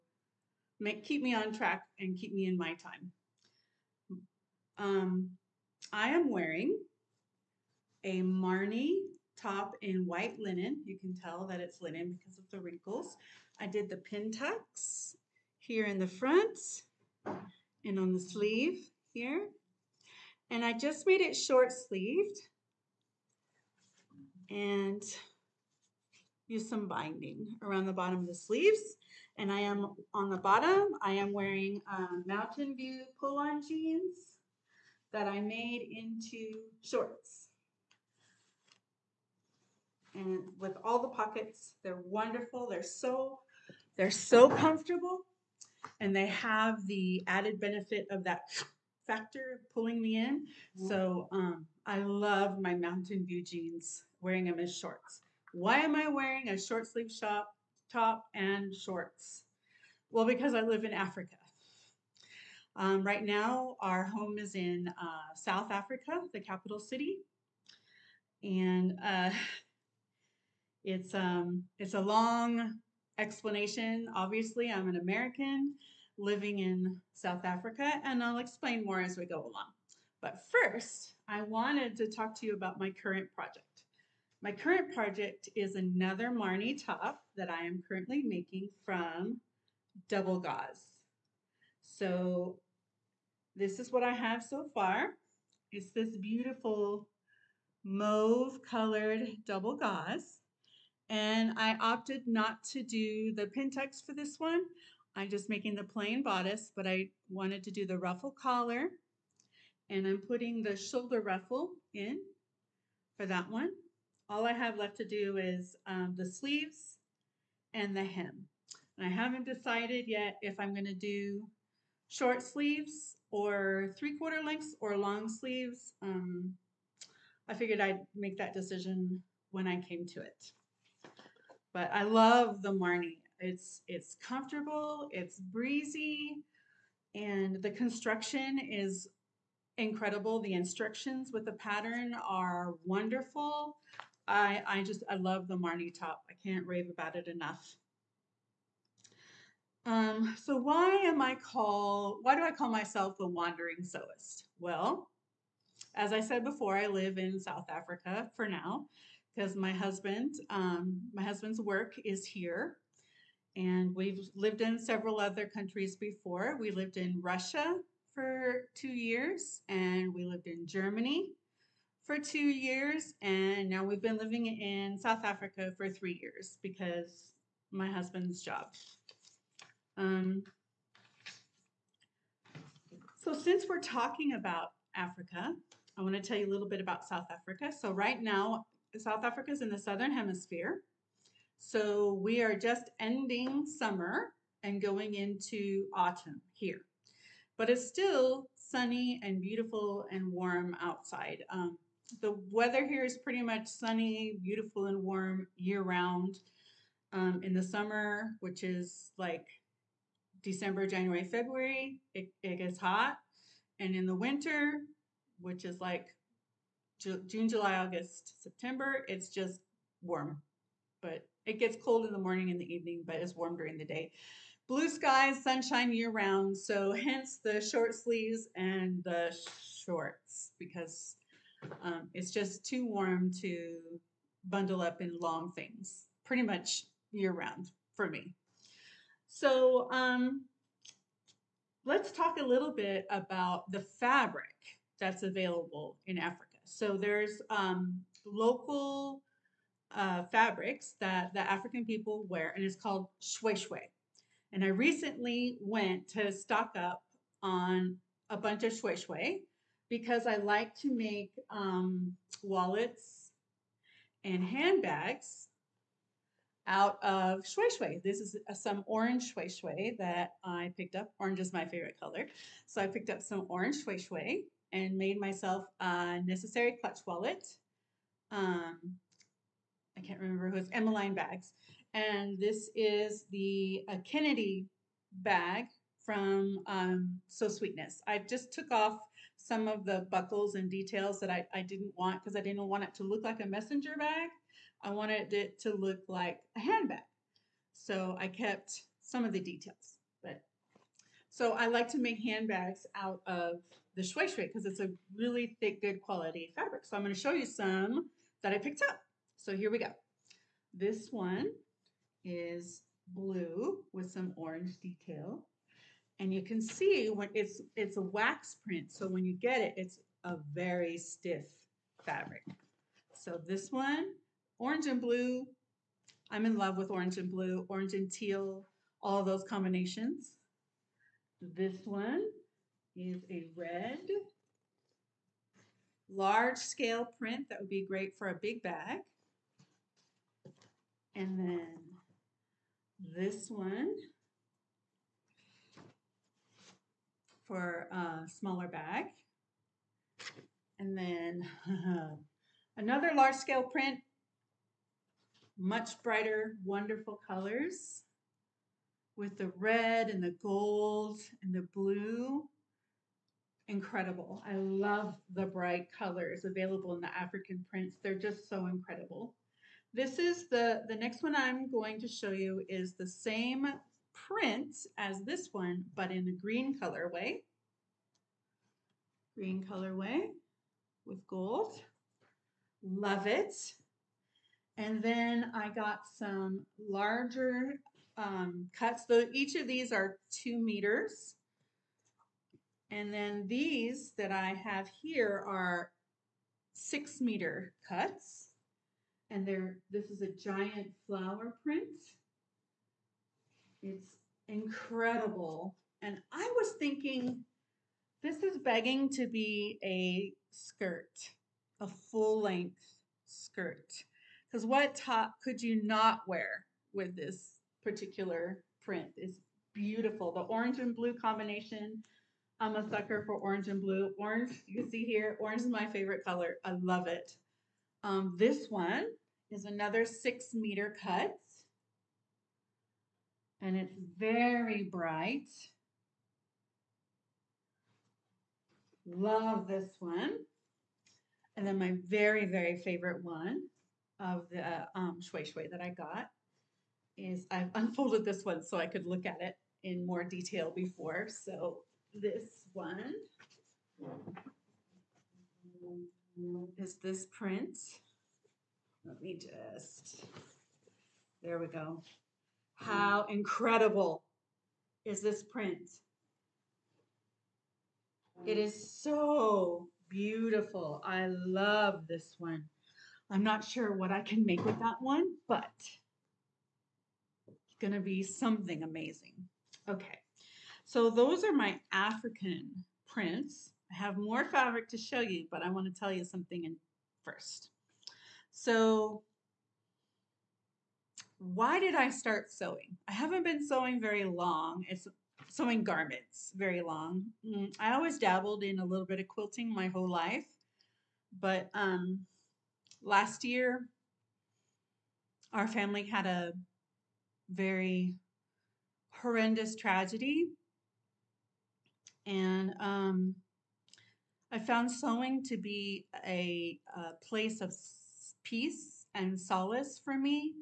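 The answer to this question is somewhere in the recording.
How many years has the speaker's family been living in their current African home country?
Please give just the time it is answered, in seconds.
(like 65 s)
175 s.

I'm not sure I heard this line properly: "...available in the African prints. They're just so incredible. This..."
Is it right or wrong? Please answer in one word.
right.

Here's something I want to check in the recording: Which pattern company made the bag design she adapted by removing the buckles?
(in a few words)
Sew Sweetness.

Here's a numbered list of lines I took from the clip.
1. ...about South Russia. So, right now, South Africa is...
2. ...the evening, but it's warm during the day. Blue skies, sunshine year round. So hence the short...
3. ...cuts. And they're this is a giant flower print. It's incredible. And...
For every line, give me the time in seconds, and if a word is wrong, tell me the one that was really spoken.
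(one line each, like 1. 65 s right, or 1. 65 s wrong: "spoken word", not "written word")
1. 186 s wrong: "Africa", not "Russia"
2. 222 s right
3. 397 s right.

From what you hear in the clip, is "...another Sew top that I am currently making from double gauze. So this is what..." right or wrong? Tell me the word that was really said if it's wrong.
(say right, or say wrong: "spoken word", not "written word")
wrong: "Marnie", not "Sew".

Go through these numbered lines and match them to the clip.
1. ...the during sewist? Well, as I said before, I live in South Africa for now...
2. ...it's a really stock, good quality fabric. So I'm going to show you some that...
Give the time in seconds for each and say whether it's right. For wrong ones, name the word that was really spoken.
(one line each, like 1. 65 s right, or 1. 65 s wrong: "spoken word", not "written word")
1. 153 s wrong: "wandering", not "during"
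2. 304 s wrong: "thick", not "stock".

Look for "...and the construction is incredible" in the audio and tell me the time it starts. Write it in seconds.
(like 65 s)
137 s.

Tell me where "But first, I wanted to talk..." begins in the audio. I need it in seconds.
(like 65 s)
80 s.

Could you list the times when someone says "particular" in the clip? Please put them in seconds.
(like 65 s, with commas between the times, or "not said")
417 s.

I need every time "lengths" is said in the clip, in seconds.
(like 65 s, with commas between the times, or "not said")
124 s, 412 s.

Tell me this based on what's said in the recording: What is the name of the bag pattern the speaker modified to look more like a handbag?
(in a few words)
Kennedy bag.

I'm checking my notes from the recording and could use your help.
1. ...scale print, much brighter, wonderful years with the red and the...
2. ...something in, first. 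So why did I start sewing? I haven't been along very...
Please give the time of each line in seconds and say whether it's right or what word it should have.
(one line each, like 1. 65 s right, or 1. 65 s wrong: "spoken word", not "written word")
1. 353 s wrong: "colors", not "years"
2. 486 s wrong: "sewing", not "along".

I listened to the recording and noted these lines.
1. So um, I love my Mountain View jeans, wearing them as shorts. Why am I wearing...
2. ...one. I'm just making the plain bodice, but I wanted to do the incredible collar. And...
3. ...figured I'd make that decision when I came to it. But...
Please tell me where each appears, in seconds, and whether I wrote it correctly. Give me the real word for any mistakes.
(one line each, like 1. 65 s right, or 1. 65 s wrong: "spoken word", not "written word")
1. 50 s right
2. 104 s wrong: "ruffle", not "incredible"
3. 127 s right.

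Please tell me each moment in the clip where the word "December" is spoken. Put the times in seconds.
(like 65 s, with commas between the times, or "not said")
210 s.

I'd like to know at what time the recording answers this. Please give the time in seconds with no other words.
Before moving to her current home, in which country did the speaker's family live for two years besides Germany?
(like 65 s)
167 s.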